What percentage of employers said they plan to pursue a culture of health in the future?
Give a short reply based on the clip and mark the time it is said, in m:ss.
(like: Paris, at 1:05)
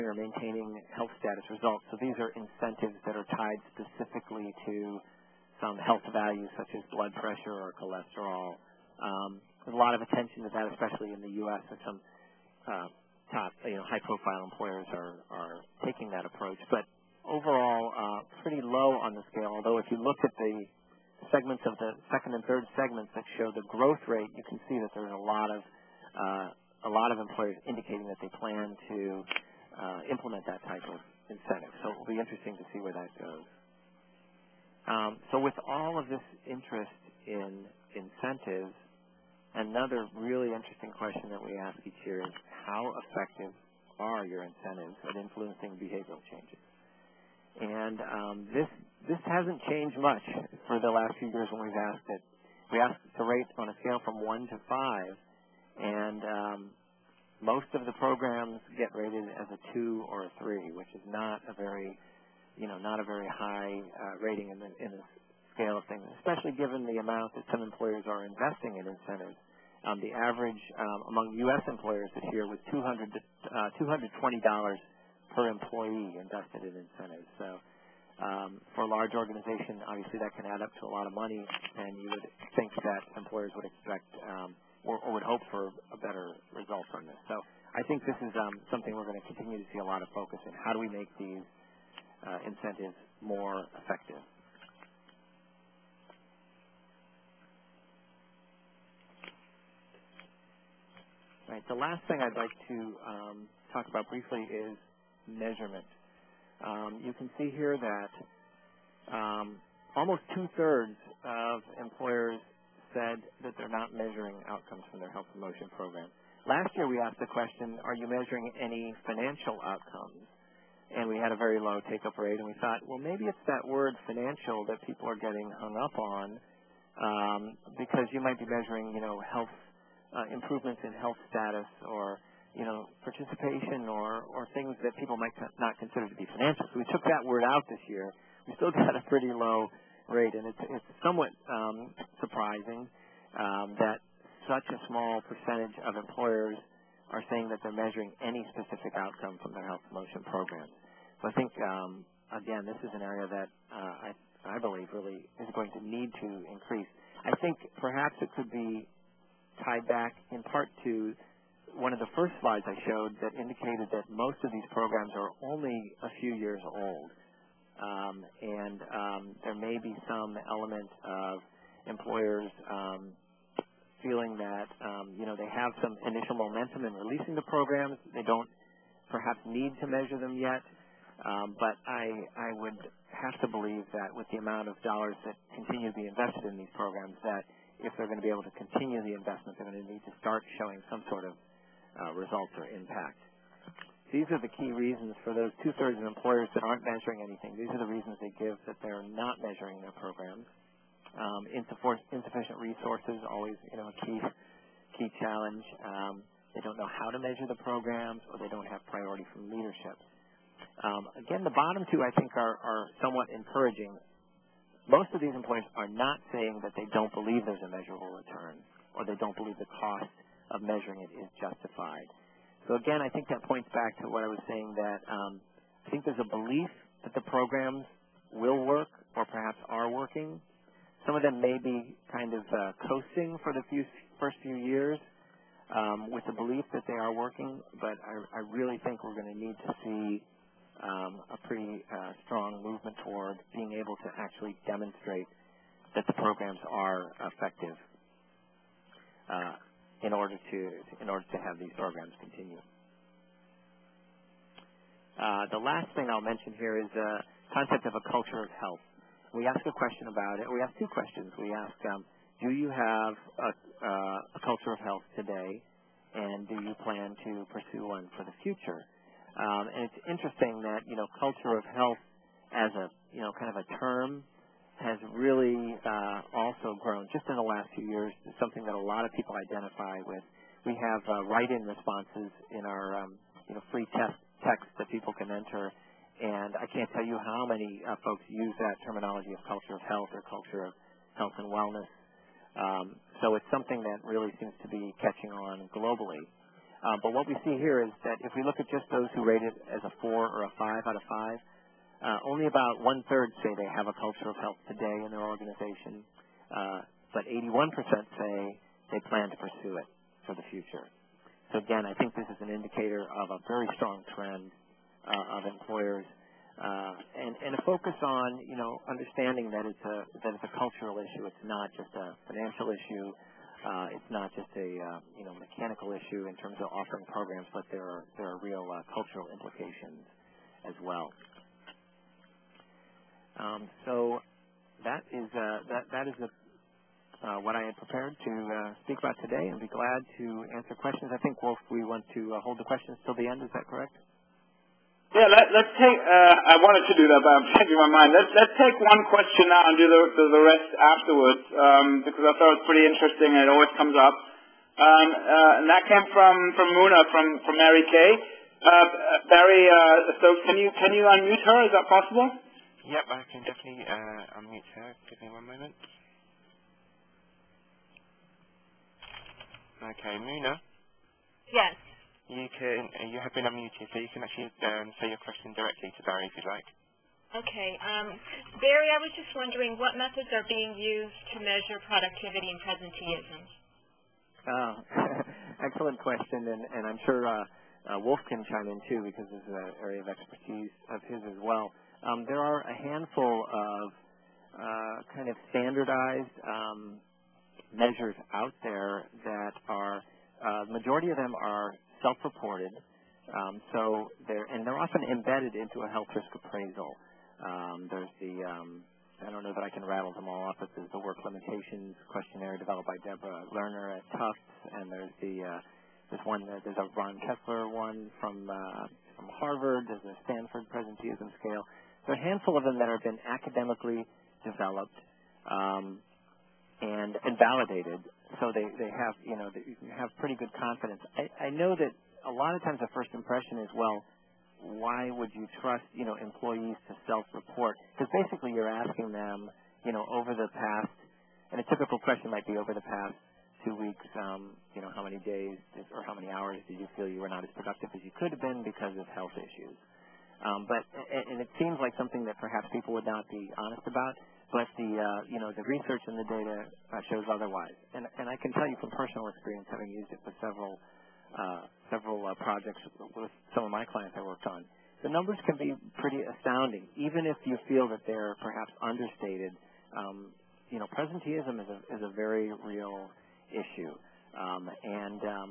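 81%, at 5:07.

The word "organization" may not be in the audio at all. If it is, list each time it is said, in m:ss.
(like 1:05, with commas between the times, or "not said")
1:19, 5:05.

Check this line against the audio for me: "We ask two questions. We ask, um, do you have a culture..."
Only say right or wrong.
right.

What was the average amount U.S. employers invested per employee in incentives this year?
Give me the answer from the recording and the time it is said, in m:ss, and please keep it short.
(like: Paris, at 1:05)
$220, at 1:13.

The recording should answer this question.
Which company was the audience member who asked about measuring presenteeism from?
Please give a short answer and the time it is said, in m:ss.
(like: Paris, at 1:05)
Mary Kay, at 5:57.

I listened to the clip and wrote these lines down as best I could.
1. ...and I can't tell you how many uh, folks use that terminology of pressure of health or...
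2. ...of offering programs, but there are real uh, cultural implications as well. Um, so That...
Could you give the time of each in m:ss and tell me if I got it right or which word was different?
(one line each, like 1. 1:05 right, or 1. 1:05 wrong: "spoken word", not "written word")
1. 4:46 wrong: "culture", not "pressure"
2. 5:26 right.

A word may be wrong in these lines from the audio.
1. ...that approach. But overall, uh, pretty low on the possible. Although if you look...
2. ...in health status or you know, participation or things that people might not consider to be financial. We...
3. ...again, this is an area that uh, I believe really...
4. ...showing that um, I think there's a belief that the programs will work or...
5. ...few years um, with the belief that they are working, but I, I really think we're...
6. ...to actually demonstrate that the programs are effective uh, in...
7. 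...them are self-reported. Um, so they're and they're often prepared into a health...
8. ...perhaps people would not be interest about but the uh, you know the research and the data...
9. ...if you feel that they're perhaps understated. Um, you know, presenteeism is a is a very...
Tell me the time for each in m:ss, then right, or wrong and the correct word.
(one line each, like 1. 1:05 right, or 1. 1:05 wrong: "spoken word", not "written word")
1. 0:16 wrong: "scale", not "possible"
2. 2:10 right
3. 2:32 right
4. 3:44 wrong: "saying", not "showing"
5. 3:54 right
6. 4:04 right
7. 6:41 wrong: "embedded", not "prepared"
8. 7:32 wrong: "honest", not "interest"
9. 7:47 right.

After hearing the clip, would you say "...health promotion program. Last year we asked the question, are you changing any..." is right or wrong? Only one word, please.
wrong.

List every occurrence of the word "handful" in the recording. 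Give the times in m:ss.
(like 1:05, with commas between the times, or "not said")
6:32, 7:02.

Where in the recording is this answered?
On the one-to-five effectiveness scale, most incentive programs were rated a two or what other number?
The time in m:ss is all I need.
1:00.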